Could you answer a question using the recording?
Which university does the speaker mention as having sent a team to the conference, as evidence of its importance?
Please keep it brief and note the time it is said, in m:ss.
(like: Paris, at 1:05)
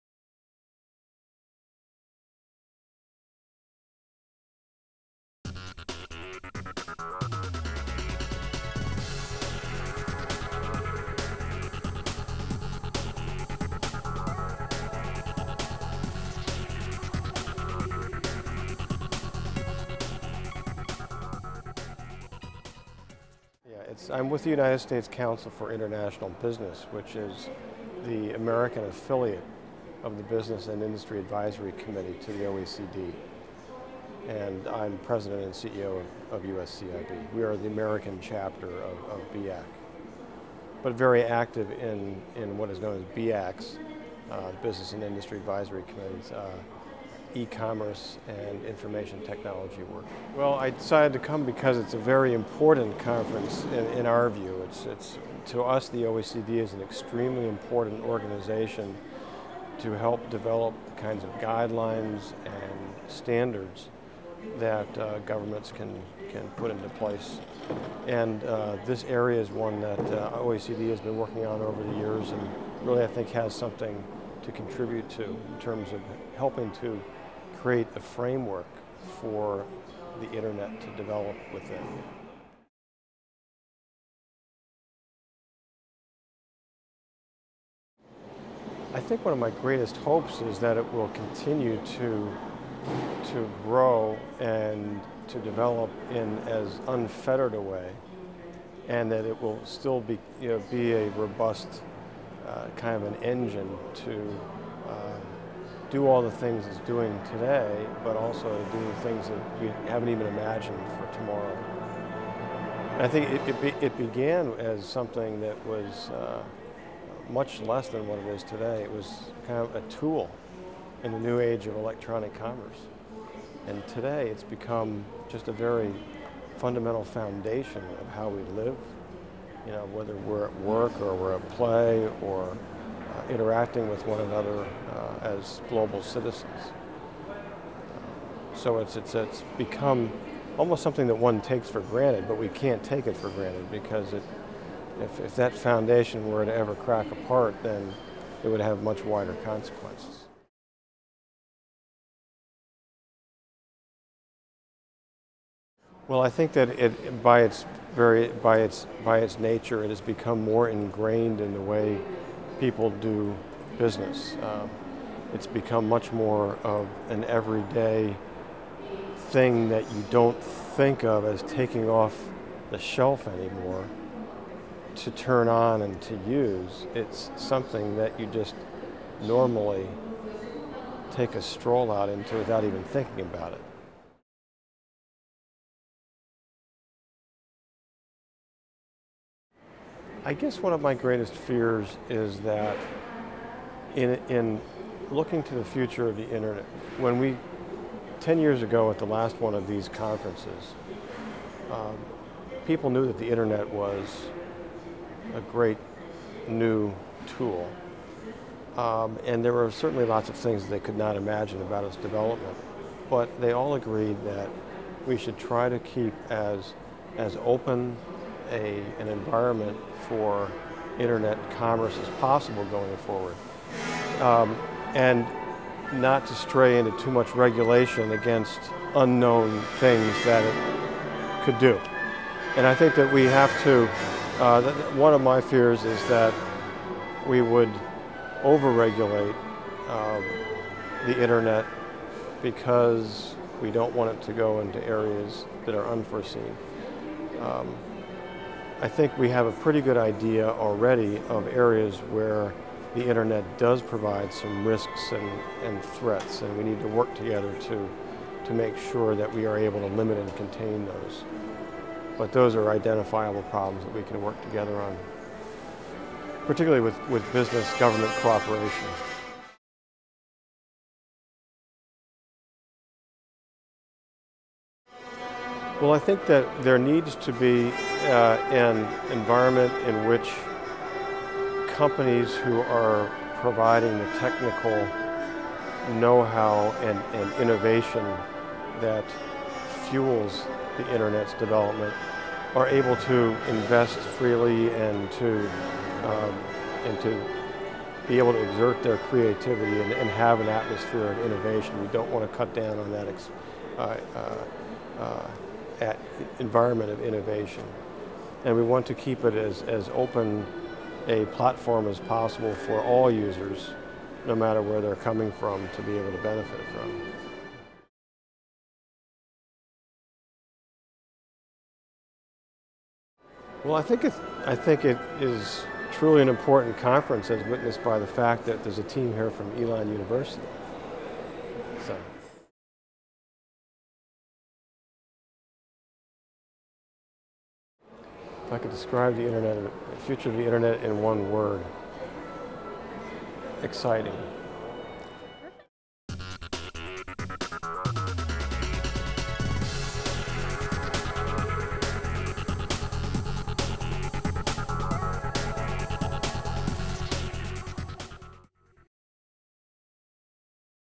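Elon University, at 5:29.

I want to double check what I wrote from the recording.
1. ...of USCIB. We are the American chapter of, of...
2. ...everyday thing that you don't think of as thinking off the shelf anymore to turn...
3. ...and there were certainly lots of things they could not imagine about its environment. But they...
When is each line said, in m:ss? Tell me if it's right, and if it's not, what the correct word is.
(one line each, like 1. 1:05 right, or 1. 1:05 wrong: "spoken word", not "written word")
1. 0:36 right
2. 2:47 wrong: "taking", not "thinking"
3. 3:29 wrong: "development", not "environment".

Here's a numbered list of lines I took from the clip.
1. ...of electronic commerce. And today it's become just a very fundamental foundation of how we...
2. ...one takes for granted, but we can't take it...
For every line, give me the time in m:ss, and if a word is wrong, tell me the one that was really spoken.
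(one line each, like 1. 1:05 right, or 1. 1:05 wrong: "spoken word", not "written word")
1. 2:01 right
2. 2:21 right.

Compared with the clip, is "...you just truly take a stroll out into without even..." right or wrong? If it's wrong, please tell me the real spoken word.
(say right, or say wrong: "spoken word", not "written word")
wrong: "normally", not "truly".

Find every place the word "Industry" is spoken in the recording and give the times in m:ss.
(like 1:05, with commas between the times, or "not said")
0:30, 0:45.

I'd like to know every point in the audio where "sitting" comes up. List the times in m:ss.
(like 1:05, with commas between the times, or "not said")
not said.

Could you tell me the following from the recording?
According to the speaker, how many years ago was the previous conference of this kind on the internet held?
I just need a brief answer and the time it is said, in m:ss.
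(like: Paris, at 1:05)
10, at 3:18.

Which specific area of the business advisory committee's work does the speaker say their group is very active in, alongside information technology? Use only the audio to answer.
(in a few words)
e-commerce.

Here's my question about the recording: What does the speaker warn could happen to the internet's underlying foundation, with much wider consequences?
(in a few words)
crack apart.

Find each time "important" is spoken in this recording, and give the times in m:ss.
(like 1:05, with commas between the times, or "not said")
0:52, 0:57, 5:26.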